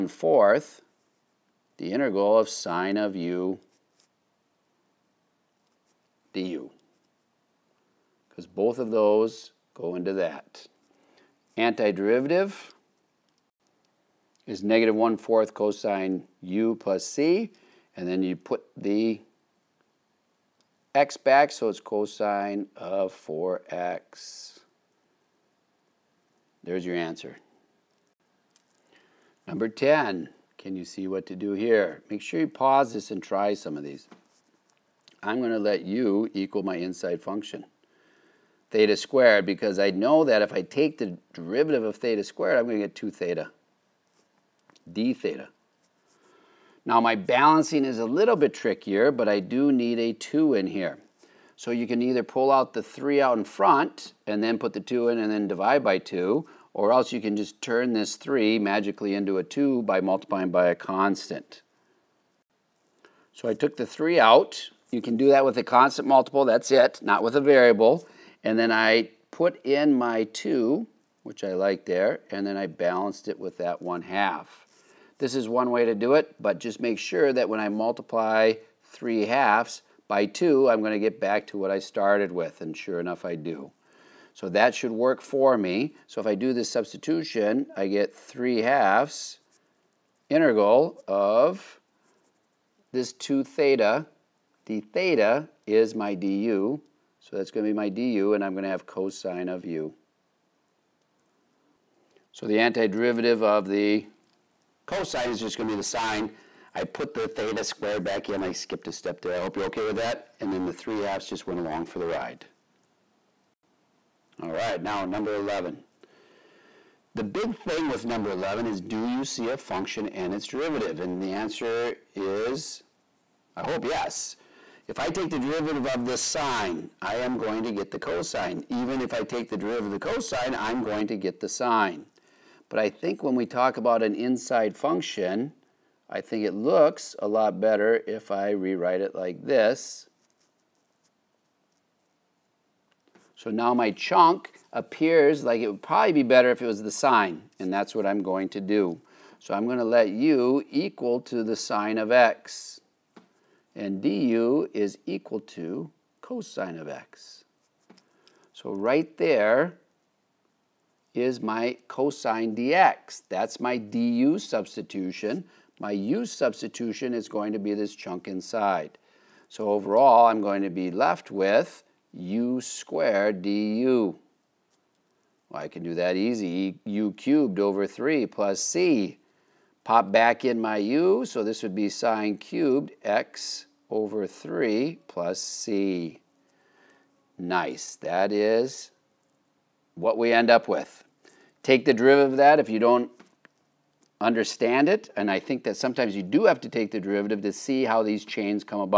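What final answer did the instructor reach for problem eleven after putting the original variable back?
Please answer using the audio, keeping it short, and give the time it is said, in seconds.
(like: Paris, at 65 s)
sin^3 x / 3 + c, at 181 s.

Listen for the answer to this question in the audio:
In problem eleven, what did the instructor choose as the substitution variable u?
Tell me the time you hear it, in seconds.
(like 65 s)
151 s.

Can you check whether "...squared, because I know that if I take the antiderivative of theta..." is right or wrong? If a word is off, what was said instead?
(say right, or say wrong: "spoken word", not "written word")
wrong: "derivative", not "antiderivative".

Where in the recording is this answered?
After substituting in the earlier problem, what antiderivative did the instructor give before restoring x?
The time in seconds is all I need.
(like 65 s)
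14 s.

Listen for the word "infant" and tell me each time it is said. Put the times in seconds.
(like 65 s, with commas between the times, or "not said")
not said.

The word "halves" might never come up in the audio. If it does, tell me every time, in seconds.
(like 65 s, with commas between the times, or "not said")
79 s, 88 s, 110 s.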